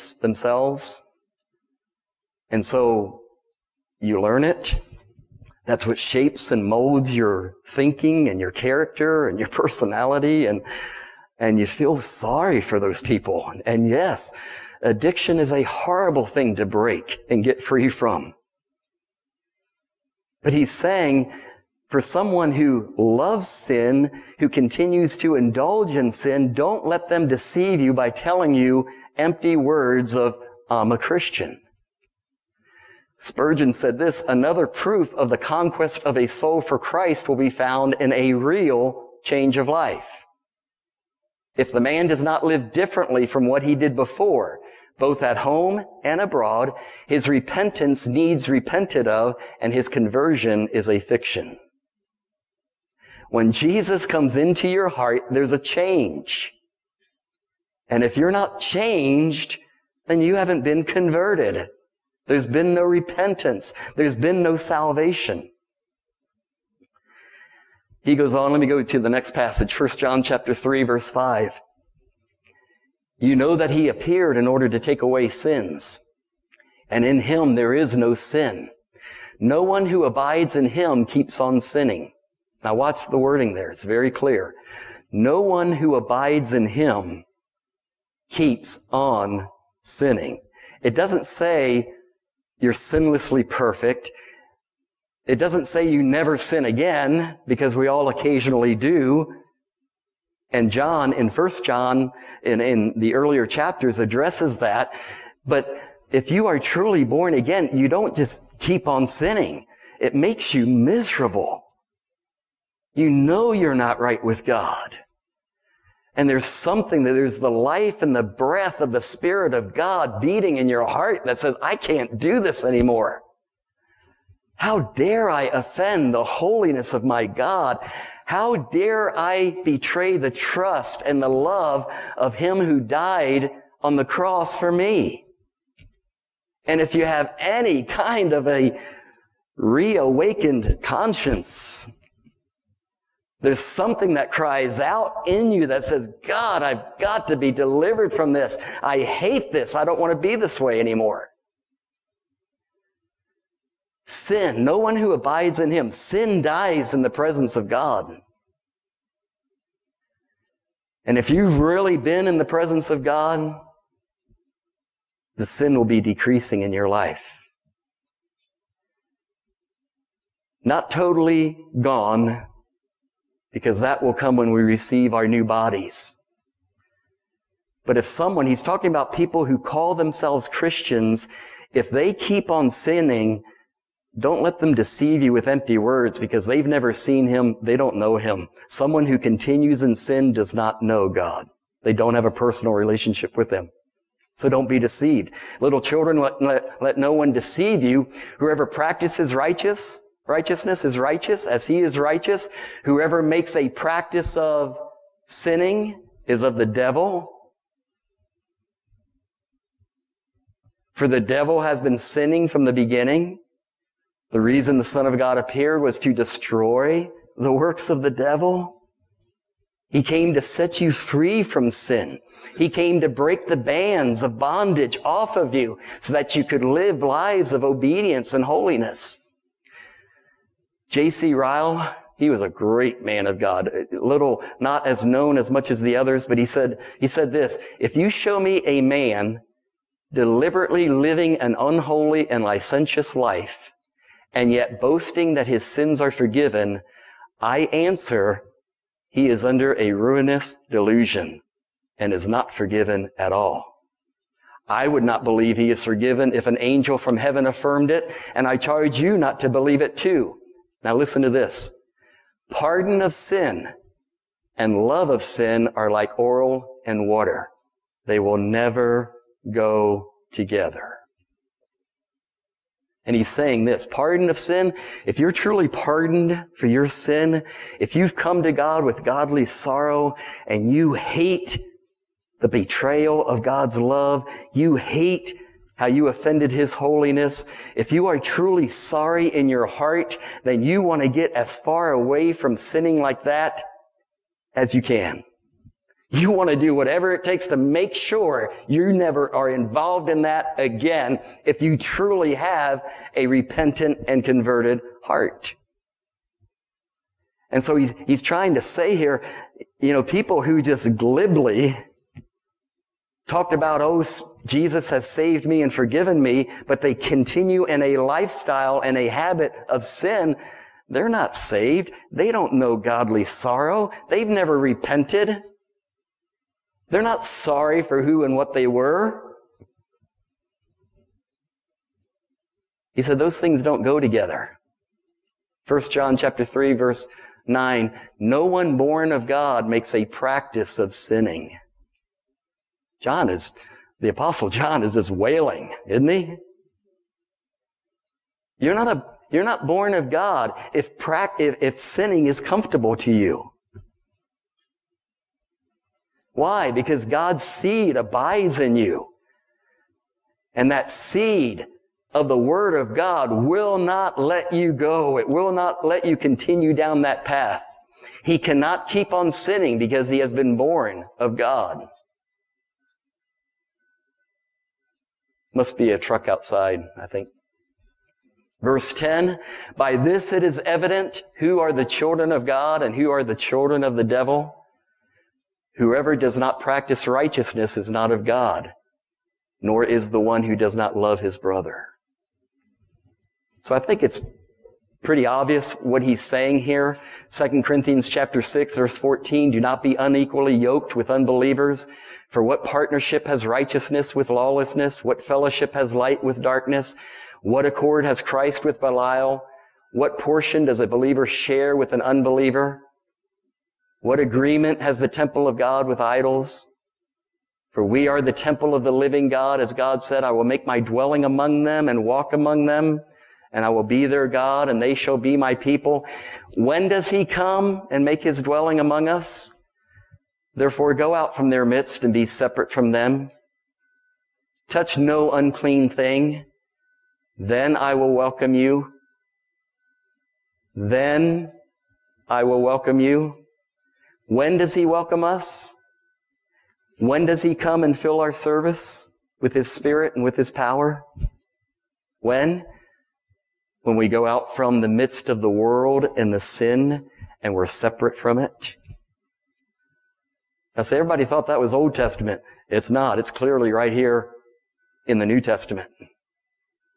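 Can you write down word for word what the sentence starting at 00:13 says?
And yes, addiction is a horrible thing to break and get free from.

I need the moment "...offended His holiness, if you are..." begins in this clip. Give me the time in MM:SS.
04:46.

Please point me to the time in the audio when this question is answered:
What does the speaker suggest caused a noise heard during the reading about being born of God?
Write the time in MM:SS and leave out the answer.
06:15.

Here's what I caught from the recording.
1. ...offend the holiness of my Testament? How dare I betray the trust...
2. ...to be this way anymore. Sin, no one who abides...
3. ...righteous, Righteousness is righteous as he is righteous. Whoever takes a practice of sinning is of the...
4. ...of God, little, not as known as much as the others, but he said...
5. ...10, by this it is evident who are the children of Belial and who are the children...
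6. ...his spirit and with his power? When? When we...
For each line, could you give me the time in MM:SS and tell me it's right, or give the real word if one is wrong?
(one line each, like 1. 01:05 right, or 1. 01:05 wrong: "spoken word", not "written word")
1. 02:05 wrong: "God", not "Testament"
2. 02:30 right
3. 03:19 wrong: "makes", not "takes"
4. 03:53 right
5. 06:18 wrong: "God", not "Belial"
6. 07:29 right.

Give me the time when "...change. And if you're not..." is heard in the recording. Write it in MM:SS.
00:55.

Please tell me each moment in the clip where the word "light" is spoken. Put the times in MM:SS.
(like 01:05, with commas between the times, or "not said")
06:45.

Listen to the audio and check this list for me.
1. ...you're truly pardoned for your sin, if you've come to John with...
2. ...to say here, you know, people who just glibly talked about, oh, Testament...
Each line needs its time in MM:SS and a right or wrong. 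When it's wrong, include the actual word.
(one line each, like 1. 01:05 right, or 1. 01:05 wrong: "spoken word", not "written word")
1. 04:35 wrong: "God", not "John"
2. 05:08 wrong: "Jesus", not "Testament".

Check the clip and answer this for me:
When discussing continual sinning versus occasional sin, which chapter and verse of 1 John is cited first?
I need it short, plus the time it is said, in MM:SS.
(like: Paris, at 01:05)
1 John 3:5, at 01:09.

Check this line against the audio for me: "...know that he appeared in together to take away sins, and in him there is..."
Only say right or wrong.
wrong.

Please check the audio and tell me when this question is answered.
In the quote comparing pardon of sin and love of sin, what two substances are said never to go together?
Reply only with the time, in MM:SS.
04:26.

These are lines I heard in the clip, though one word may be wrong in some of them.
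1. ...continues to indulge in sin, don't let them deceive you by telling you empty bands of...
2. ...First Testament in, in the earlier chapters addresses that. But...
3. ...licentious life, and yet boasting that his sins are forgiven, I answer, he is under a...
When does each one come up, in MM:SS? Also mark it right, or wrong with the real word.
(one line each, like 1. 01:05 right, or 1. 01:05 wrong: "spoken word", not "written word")
1. 00:24 wrong: "words", not "bands"
2. 01:41 wrong: "John", not "Testament"
3. 04:02 right.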